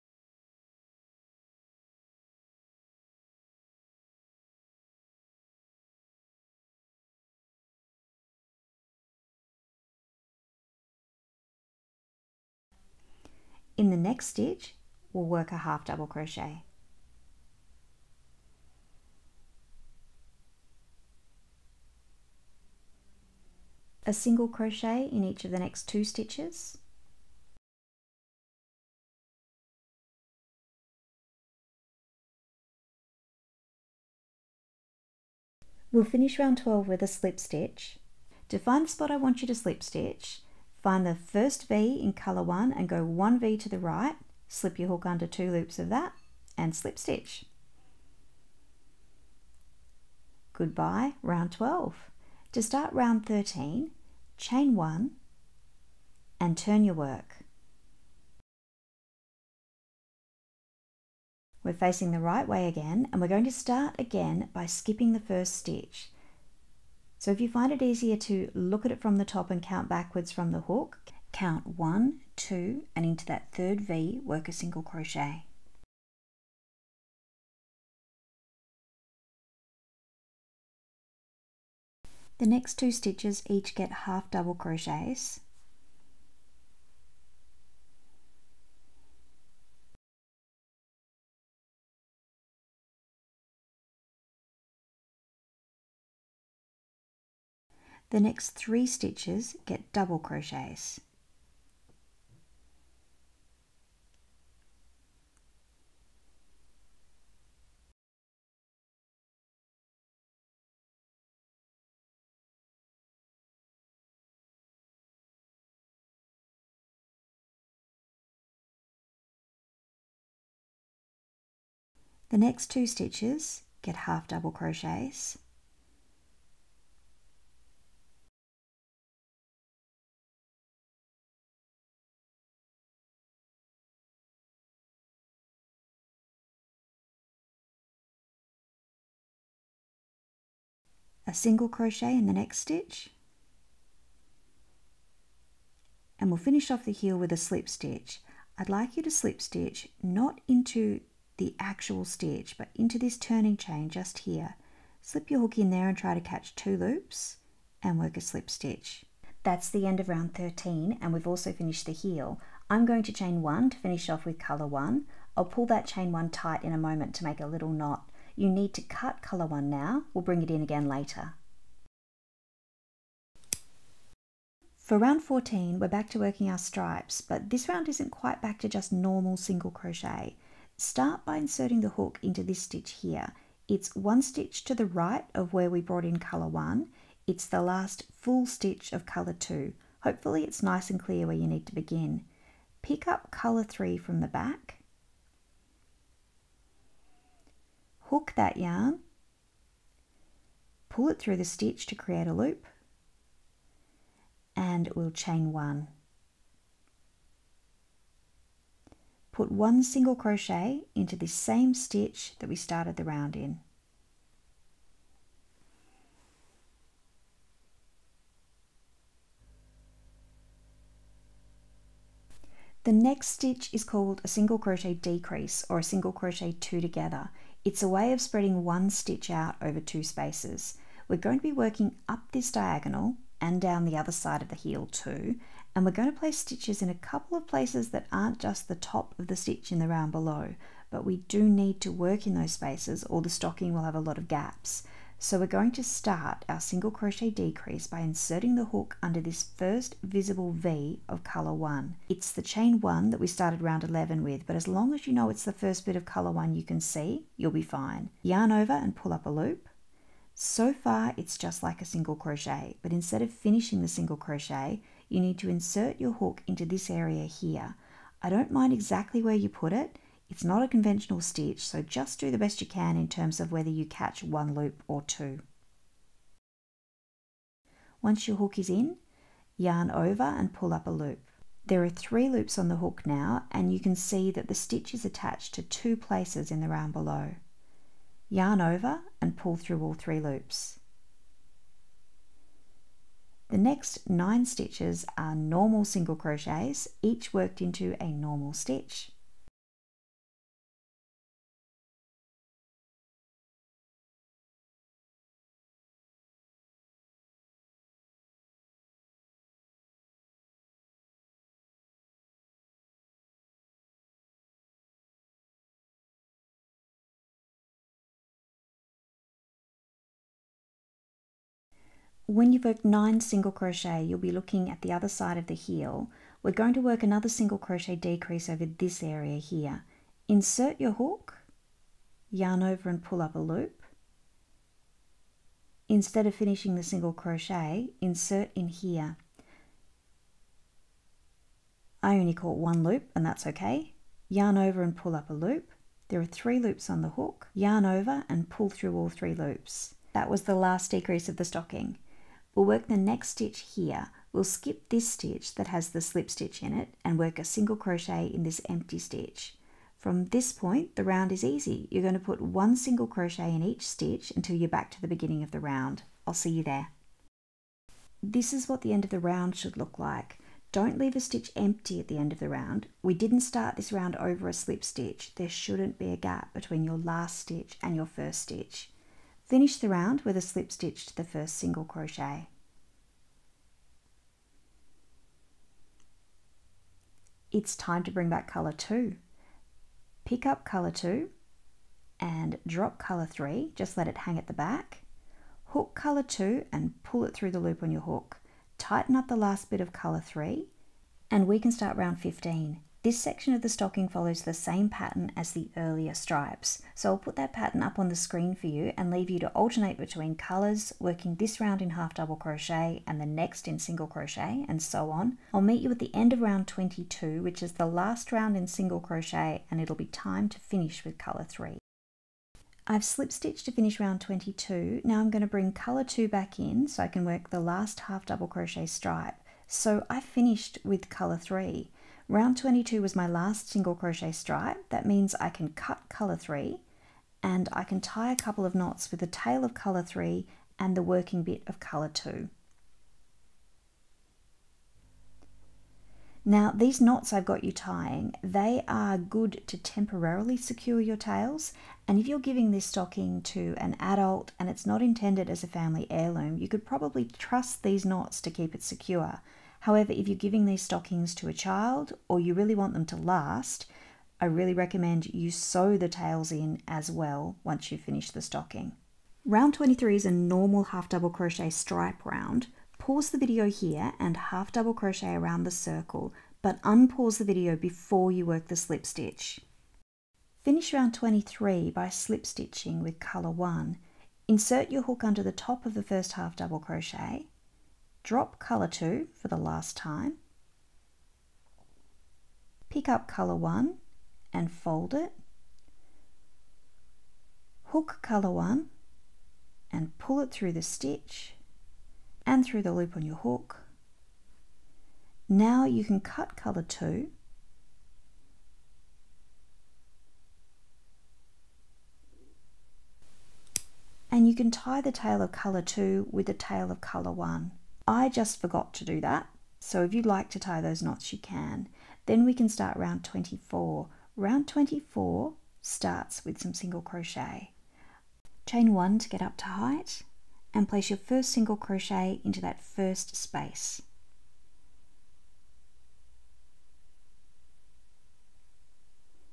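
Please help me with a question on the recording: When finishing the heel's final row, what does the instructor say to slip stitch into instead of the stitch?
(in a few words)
turning chain.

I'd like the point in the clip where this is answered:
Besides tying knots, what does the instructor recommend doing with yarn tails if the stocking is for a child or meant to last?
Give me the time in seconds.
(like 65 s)
465 s.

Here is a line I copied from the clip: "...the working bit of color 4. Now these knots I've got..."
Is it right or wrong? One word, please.
wrong.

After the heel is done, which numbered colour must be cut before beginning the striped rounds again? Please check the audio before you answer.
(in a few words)
colour 1.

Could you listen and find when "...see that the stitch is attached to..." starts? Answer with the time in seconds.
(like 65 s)
283 s.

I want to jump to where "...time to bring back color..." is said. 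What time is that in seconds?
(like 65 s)
387 s.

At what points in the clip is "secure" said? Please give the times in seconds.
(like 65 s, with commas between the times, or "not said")
450 s, 458 s.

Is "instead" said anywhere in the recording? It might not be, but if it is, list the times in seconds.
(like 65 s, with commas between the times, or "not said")
262 s, 335 s.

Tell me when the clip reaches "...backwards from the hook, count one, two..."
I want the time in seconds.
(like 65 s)
69 s.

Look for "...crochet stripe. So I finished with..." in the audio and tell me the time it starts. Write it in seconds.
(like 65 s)
428 s.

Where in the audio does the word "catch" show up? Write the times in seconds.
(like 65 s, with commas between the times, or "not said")
156 s, 273 s.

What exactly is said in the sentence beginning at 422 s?
I've slip stitched to finish round 22.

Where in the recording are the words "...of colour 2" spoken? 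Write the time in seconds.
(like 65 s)
188 s.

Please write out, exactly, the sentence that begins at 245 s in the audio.
So we're going to start our single crochet decrease by inserting the hook under this first visible V of color 1.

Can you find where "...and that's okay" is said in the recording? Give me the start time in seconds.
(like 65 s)
343 s.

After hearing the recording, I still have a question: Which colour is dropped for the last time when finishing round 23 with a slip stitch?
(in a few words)
color 2.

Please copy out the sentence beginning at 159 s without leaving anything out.
That's the end of round 13 and we've also finished the heel.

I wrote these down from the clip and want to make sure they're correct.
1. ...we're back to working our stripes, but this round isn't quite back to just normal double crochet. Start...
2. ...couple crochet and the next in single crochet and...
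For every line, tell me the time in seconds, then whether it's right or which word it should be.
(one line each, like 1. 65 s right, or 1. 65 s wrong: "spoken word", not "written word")
1. 175 s wrong: "single", not "double"
2. 412 s wrong: "double", not "couple".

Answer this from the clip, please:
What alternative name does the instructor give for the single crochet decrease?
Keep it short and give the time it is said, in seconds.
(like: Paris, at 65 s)
single crochet two together, at 225 s.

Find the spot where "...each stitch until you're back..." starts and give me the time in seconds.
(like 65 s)
363 s.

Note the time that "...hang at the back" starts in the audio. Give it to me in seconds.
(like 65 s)
394 s.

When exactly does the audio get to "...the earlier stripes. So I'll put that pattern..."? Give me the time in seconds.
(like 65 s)
405 s.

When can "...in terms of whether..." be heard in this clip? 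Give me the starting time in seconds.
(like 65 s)
272 s.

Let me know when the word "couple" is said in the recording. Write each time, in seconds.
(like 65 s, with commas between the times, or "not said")
236 s, 438 s.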